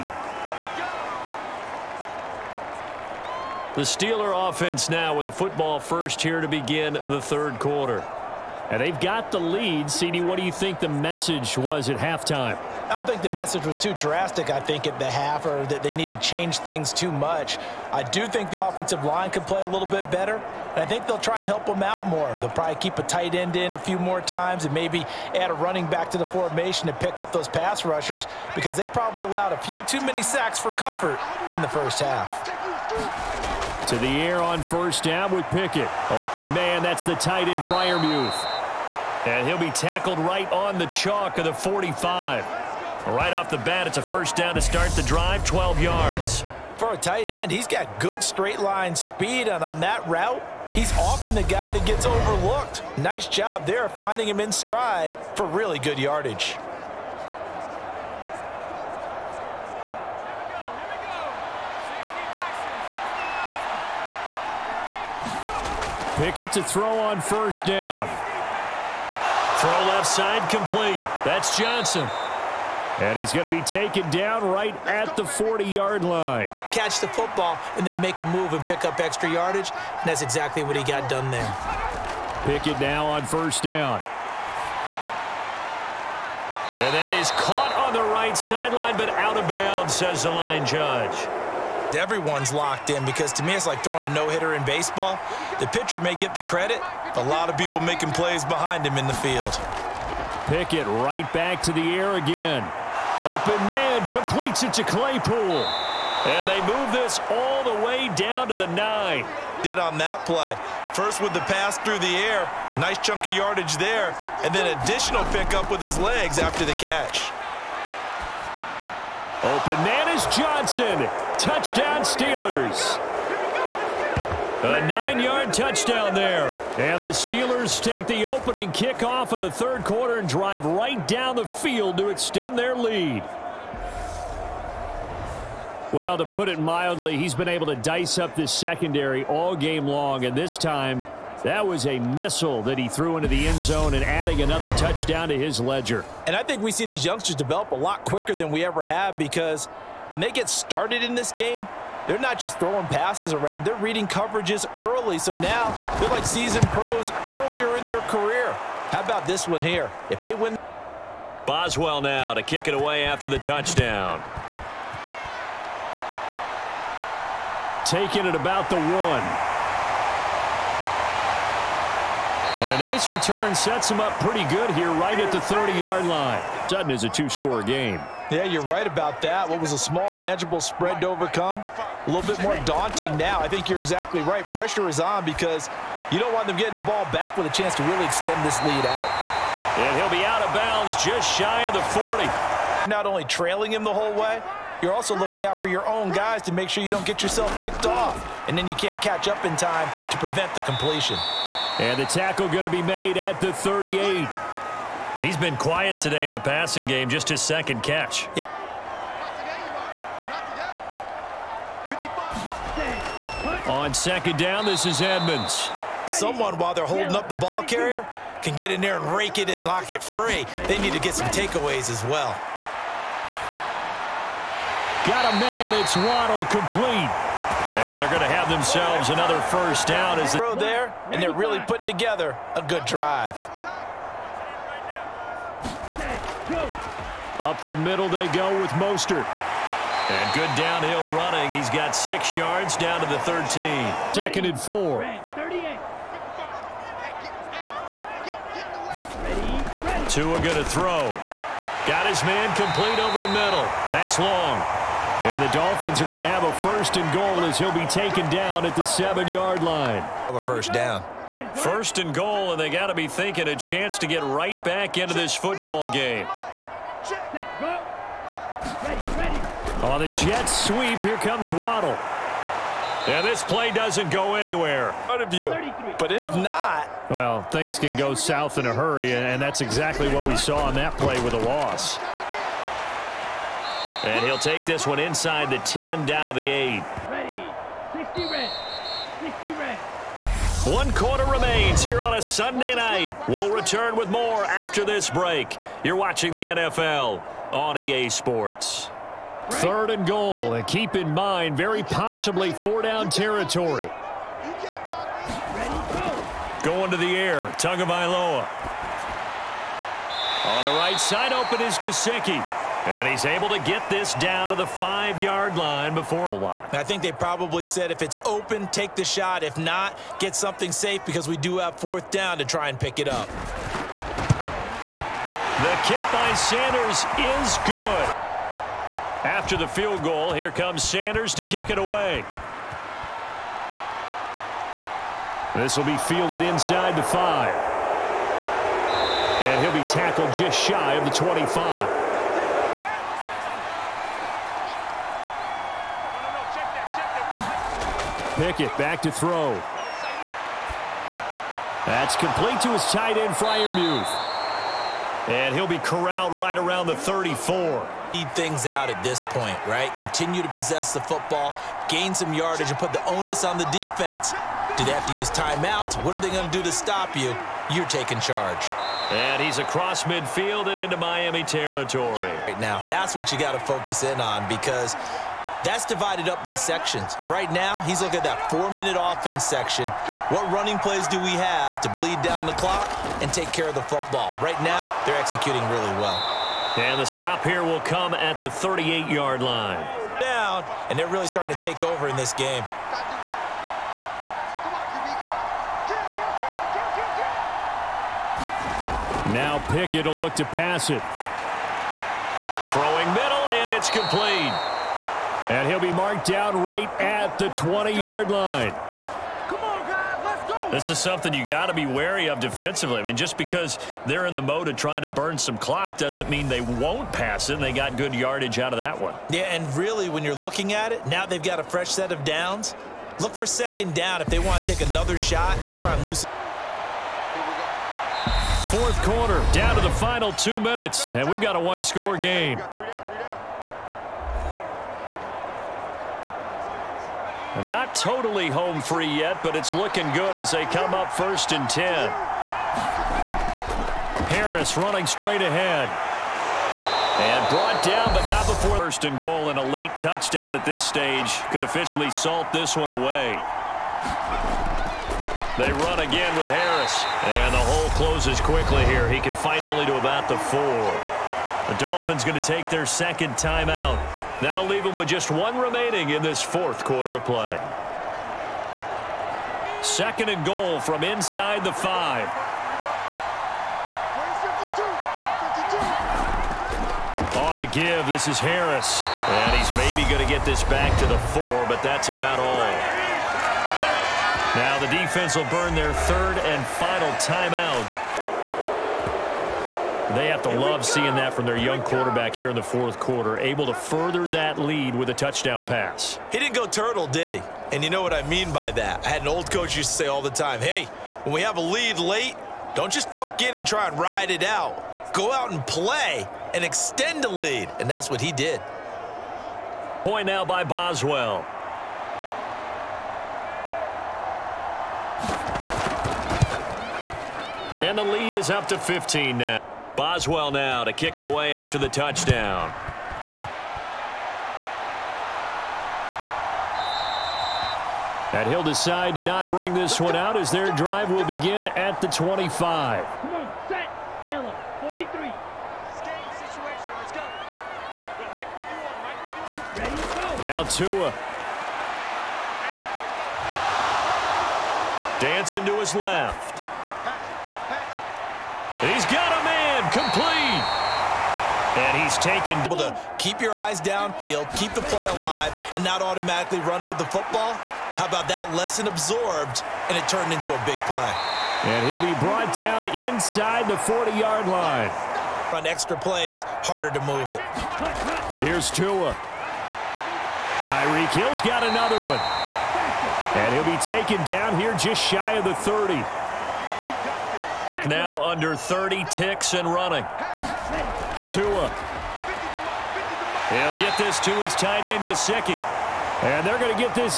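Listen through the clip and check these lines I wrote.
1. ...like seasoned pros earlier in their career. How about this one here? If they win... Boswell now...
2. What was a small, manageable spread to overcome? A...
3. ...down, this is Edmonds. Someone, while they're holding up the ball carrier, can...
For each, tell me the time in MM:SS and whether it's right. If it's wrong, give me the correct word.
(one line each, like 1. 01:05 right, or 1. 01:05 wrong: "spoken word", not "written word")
1. 02:36 right
2. 02:59 right
3. 03:34 right.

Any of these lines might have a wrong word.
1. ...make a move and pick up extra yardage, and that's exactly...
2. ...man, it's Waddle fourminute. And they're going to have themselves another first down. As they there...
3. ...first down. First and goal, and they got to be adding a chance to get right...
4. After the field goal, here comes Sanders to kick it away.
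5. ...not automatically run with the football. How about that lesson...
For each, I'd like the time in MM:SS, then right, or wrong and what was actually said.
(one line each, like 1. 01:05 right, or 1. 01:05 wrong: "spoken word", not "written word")
1. 01:18 right
2. 03:45 wrong: "complete", not "fourminute"
3. 04:20 wrong: "thinking", not "adding"
4. 05:29 right
5. 09:15 right.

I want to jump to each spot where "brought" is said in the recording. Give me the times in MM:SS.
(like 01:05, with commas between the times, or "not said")
07:27, 09:22.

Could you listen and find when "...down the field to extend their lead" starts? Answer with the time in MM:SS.
02:11.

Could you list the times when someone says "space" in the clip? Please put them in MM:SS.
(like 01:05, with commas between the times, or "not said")
not said.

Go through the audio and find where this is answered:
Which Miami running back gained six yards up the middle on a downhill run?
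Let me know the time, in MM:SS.
03:58.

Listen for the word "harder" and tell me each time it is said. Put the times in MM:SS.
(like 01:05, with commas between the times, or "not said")
09:26.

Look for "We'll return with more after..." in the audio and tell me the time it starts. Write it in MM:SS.
04:53.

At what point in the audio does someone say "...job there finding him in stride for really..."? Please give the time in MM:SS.
00:53.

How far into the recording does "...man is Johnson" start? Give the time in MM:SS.
01:59.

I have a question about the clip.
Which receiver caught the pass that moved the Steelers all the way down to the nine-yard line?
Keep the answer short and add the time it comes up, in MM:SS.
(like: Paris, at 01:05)
Claypool, at 01:44.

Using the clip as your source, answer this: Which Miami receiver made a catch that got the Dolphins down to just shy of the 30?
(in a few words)
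Tyreek Hill.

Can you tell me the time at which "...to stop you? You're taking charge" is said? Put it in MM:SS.
06:06.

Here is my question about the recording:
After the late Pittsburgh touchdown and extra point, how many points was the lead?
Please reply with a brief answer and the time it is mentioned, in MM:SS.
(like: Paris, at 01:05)
15, at 08:38.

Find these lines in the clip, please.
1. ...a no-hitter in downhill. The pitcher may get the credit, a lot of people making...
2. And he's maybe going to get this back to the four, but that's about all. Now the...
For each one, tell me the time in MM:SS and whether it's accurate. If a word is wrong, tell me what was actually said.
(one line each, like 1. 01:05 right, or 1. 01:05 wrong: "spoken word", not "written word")
1. 01:34 wrong: "baseball", not "downhill"
2. 07:59 right.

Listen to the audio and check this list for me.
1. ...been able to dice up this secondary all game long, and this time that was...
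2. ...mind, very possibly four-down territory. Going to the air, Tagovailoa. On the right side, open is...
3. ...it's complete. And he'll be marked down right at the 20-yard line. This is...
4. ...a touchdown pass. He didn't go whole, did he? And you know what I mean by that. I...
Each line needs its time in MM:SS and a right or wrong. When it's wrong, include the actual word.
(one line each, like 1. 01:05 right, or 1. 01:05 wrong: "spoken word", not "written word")
1. 02:17 right
2. 05:01 right
3. 06:43 right
4. 08:15 wrong: "turtle", not "whole".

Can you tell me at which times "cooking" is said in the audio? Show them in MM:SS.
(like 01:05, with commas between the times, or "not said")
not said.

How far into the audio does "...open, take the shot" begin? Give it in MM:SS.
05:18.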